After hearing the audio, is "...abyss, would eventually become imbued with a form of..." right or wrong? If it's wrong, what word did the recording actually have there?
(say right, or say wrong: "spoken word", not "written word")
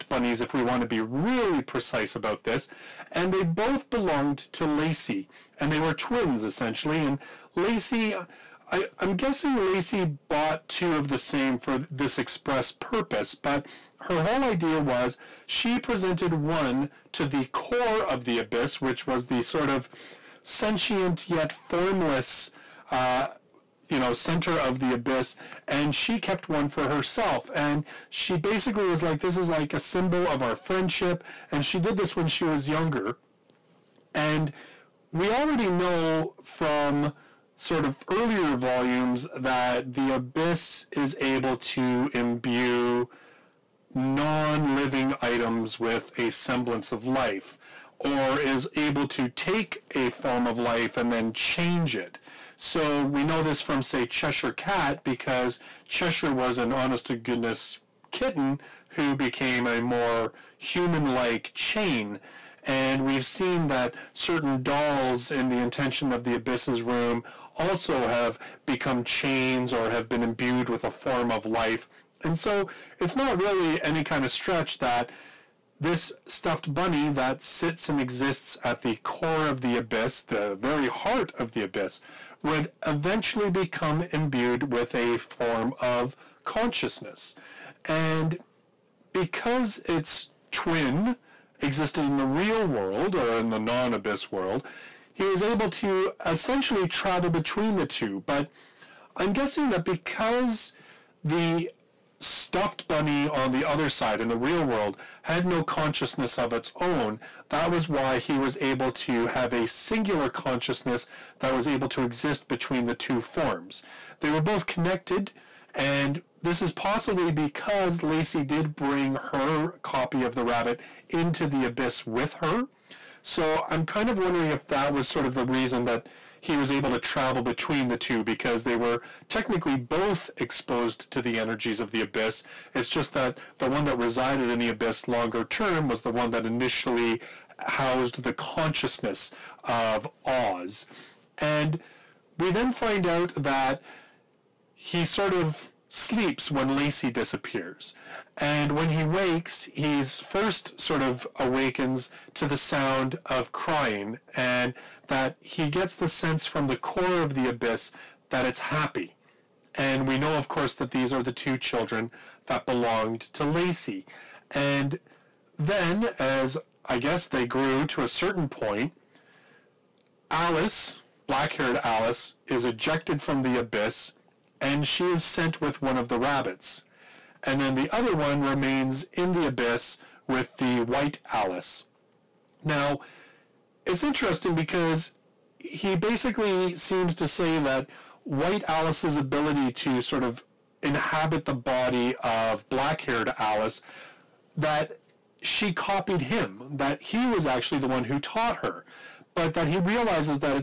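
right.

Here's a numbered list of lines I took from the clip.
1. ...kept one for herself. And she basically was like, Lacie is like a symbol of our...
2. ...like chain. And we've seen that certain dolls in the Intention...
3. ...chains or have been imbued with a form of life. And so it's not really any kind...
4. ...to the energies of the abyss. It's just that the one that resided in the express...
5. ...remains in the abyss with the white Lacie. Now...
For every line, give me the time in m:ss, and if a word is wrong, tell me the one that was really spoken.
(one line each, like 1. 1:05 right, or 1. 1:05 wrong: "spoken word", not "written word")
1. 0:26 wrong: "This", not "Lacie"
2. 1:01 right
3. 1:09 right
4. 2:11 wrong: "abyss", not "express"
5. 2:58 wrong: "Alice", not "Lacie".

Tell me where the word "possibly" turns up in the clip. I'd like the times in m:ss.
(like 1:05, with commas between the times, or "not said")
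1:56.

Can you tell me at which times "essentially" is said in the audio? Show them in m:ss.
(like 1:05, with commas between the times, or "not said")
0:06, 1:36.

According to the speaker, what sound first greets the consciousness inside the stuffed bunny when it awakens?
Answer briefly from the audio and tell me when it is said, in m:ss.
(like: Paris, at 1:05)
crying, at 2:33.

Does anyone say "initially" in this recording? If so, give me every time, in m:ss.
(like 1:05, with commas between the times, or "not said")
2:16.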